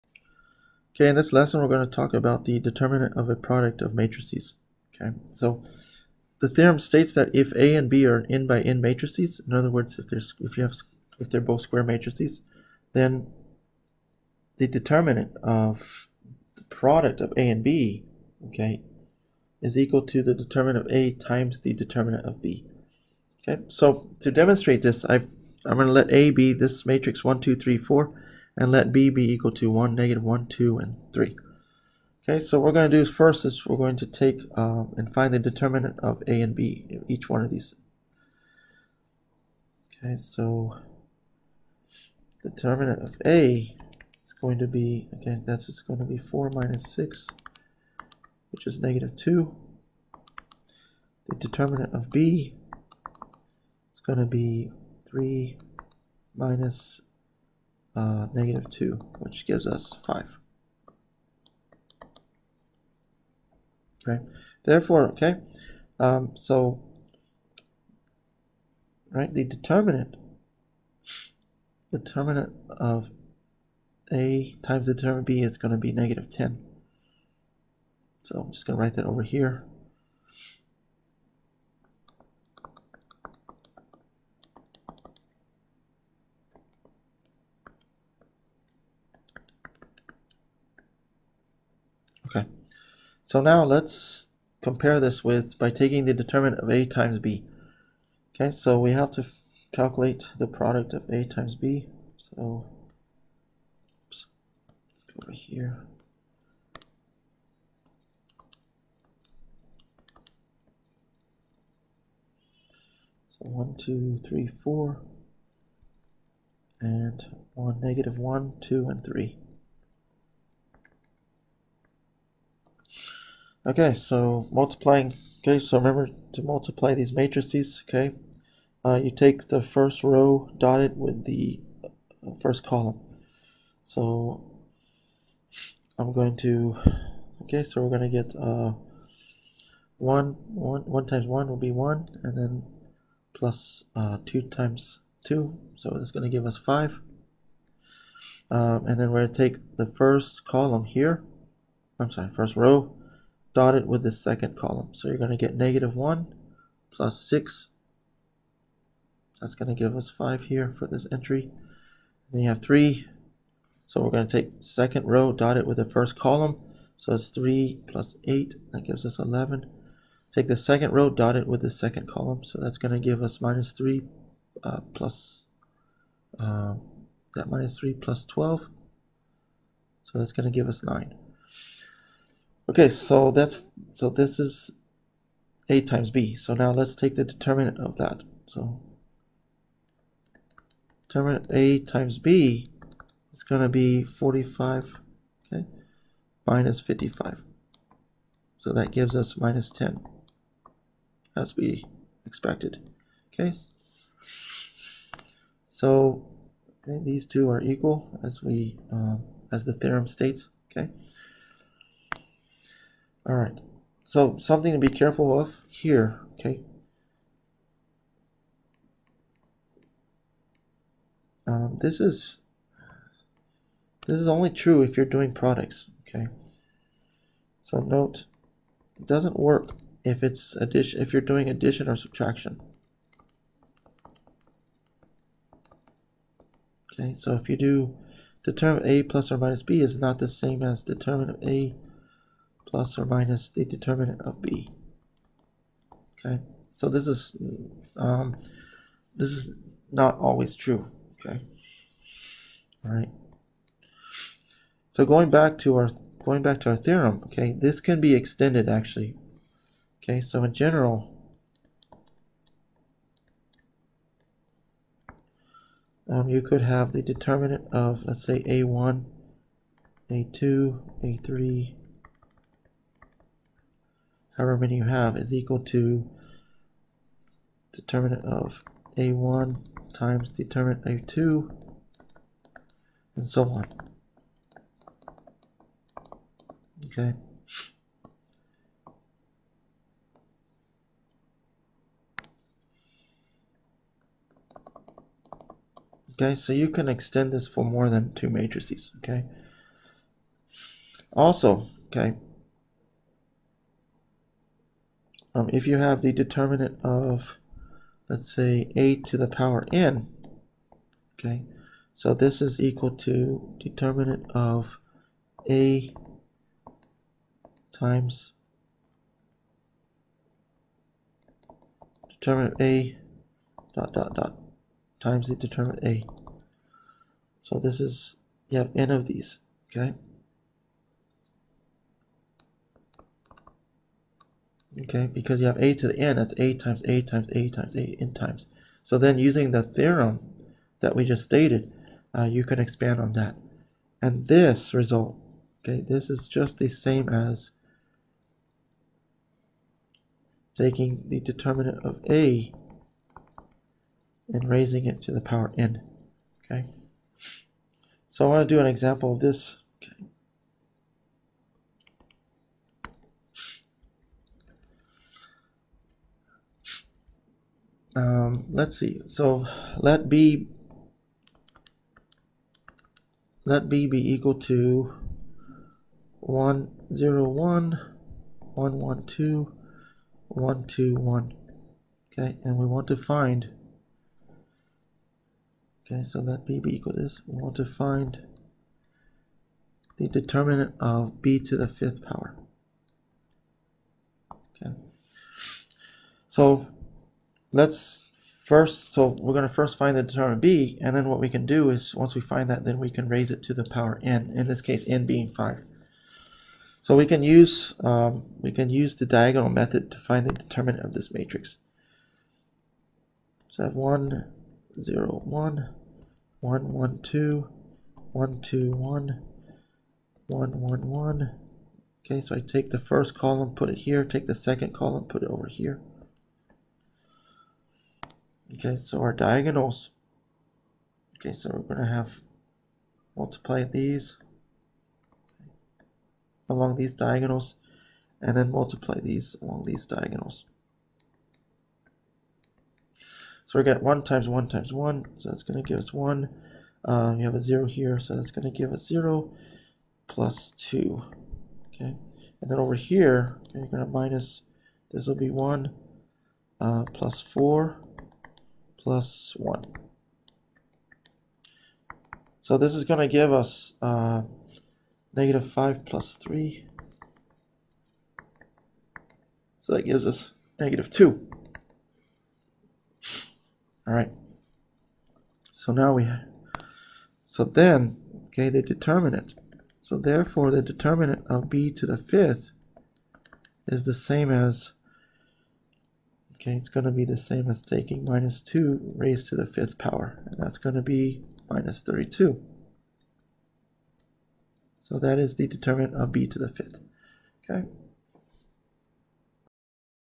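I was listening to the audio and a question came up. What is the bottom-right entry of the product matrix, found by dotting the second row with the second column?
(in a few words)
9.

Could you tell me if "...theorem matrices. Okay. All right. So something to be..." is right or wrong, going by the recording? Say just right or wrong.
wrong.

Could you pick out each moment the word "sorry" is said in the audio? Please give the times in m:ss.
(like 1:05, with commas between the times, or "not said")
2:32.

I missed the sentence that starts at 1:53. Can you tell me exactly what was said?
So one, two, three, four, and one, negative one, two, and three.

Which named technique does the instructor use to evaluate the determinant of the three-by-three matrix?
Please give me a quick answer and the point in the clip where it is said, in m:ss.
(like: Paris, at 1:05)
diagonal method, at 6:49.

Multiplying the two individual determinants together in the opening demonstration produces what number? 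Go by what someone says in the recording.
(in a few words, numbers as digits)
-10.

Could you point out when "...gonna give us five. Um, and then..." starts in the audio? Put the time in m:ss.
2:26.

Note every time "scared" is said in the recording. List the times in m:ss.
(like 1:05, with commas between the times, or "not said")
not said.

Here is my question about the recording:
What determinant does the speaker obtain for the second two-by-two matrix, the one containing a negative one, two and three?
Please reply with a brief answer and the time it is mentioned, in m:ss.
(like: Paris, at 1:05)
5, at 0:59.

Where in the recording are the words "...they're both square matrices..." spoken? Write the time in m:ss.
0:11.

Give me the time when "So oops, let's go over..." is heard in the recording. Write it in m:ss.
1:42.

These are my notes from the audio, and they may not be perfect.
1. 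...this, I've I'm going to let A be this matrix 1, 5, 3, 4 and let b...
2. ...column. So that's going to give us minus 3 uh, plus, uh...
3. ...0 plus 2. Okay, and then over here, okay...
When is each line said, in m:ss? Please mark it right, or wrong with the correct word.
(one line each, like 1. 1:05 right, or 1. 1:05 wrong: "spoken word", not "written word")
1. 0:24 wrong: "2", not "5"
2. 2:52 right
3. 7:28 right.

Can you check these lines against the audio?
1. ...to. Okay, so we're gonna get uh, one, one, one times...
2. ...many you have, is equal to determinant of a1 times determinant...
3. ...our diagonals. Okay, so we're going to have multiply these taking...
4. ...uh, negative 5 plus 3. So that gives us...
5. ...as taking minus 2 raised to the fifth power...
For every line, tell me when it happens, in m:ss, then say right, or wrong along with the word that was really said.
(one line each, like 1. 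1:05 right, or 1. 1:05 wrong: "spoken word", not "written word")
1. 2:16 right
2. 4:34 right
3. 7:09 wrong: "along", not "taking"
4. 7:43 right
5. 8:07 right.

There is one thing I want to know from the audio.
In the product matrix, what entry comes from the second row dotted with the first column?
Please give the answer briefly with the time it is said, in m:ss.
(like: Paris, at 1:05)
11, at 2:48.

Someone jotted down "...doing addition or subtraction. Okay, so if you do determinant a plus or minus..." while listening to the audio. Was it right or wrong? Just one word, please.
right.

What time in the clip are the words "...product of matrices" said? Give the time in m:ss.
0:03.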